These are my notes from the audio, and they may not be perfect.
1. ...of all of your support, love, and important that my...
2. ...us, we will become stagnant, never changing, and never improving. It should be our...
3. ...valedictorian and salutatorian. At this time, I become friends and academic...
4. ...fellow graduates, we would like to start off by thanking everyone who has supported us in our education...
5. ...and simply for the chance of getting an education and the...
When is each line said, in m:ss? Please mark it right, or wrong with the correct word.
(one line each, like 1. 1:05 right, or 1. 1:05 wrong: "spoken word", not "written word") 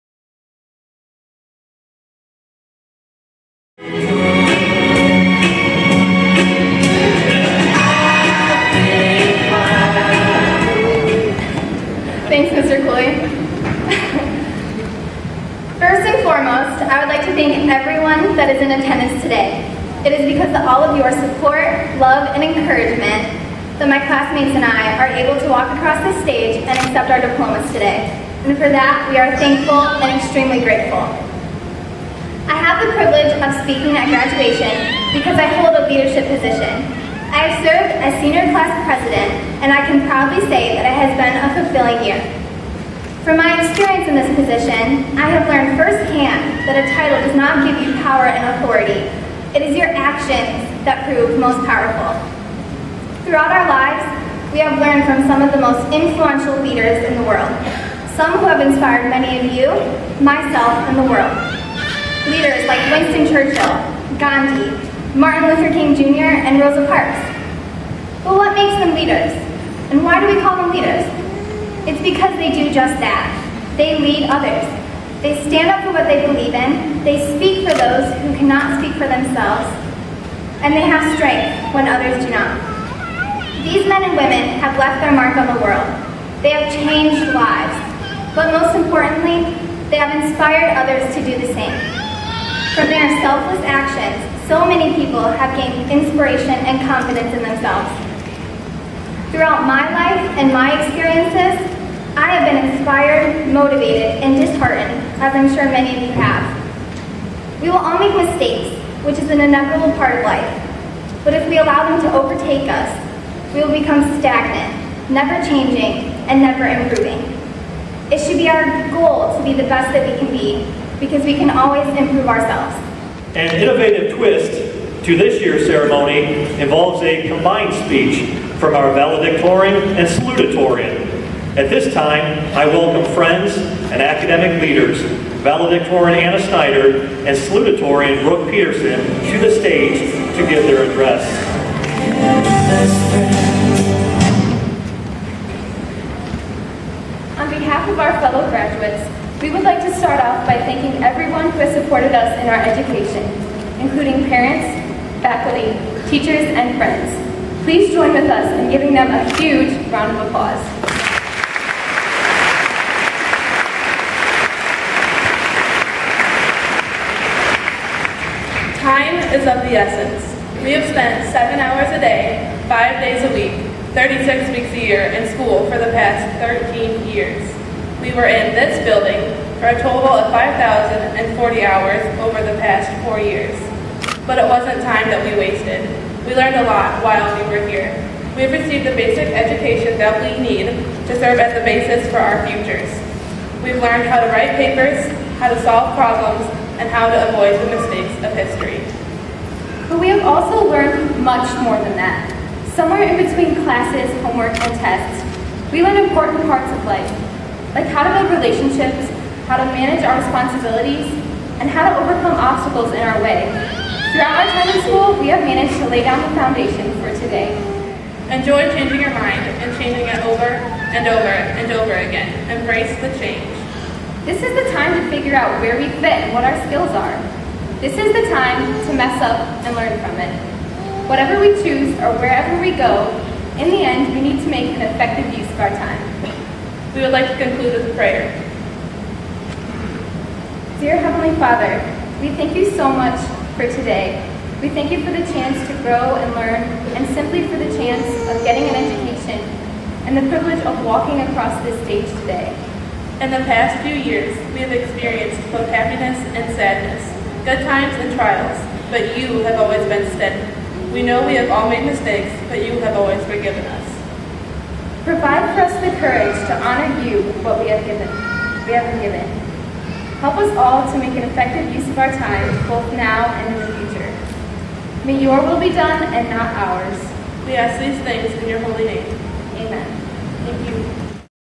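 1. 0:20 wrong: "encouragement", not "important"
2. 1:52 right
3. 2:08 wrong: "welcome", not "become"
4. 2:28 right
5. 4:06 right.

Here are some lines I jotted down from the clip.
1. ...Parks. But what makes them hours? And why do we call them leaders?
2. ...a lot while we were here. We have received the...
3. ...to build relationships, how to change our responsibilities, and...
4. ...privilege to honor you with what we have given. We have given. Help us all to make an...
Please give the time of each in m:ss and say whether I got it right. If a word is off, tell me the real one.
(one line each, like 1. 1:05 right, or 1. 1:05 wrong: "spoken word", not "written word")
1. 1:06 wrong: "leaders", not "hours"
2. 3:06 right
3. 3:28 wrong: "manage", not "change"
4. 4:26 wrong: "courage", not "privilege".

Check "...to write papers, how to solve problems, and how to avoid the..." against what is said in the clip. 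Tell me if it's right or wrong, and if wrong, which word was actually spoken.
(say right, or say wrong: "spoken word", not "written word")
right.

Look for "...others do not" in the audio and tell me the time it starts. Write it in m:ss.
1:21.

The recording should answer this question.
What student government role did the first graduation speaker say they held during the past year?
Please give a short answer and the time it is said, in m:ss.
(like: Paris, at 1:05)
Senior class president, at 0:38.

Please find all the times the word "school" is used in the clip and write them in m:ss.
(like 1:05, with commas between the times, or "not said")
2:55, 3:34.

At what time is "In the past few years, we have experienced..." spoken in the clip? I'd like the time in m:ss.
4:13.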